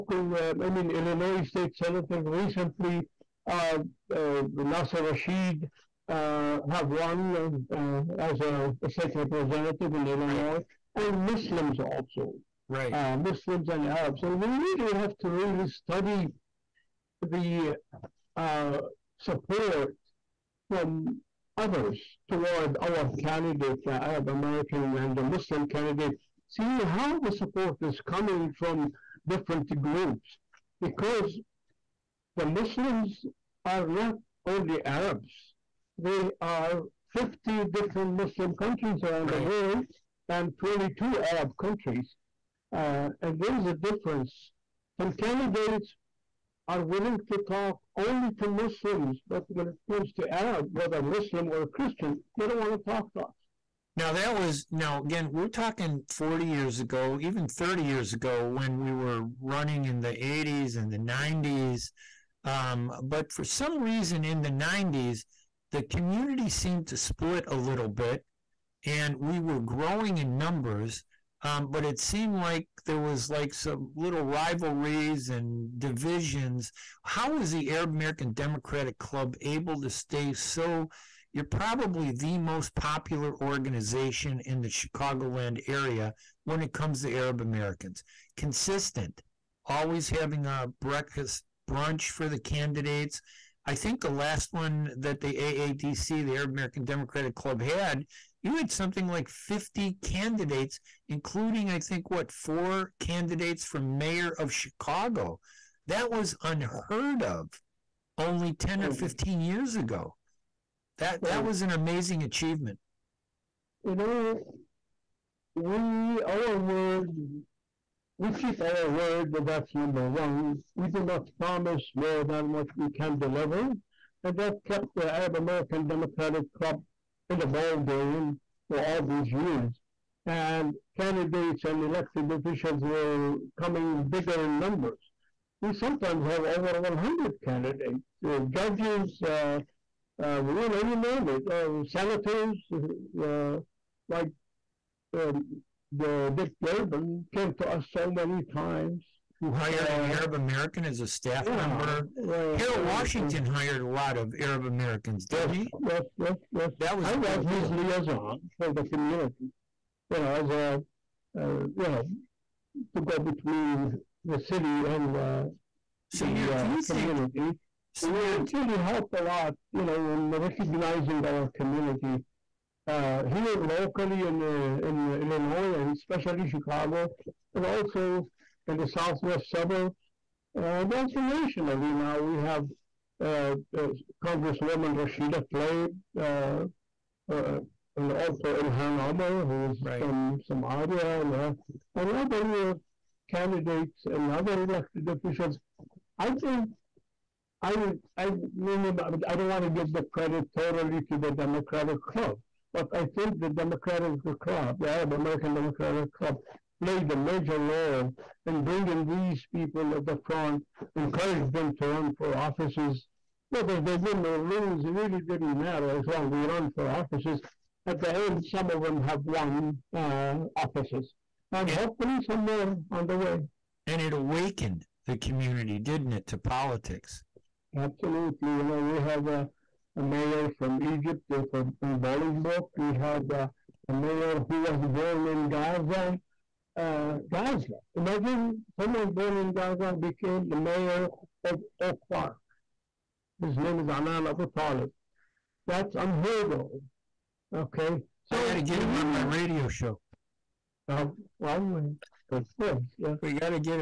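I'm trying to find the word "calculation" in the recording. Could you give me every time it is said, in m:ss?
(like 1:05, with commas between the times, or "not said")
not said.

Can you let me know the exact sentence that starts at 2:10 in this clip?
And candidates and elected officials they were coming bigger in numbers.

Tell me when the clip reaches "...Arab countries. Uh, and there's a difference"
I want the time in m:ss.
0:41.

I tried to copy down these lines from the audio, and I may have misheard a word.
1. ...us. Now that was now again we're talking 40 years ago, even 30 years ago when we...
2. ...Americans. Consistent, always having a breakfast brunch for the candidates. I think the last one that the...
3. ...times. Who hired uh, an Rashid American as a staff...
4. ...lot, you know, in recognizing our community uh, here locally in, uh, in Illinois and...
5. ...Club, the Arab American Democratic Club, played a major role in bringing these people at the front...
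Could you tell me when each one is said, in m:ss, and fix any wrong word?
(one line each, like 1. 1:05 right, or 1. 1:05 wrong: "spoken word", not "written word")
1. 0:53 right
2. 1:27 right
3. 2:28 wrong: "Arab", not "Rashid"
4. 2:49 right
5. 3:24 right.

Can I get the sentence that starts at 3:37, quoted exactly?
At the end, some of them have won uh, offices, and, and hopefully some more on the way.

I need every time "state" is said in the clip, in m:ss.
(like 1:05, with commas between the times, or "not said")
0:01, 0:08.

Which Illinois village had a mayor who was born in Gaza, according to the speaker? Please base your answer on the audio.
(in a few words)
Oak Park.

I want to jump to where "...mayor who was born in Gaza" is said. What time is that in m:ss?
3:53.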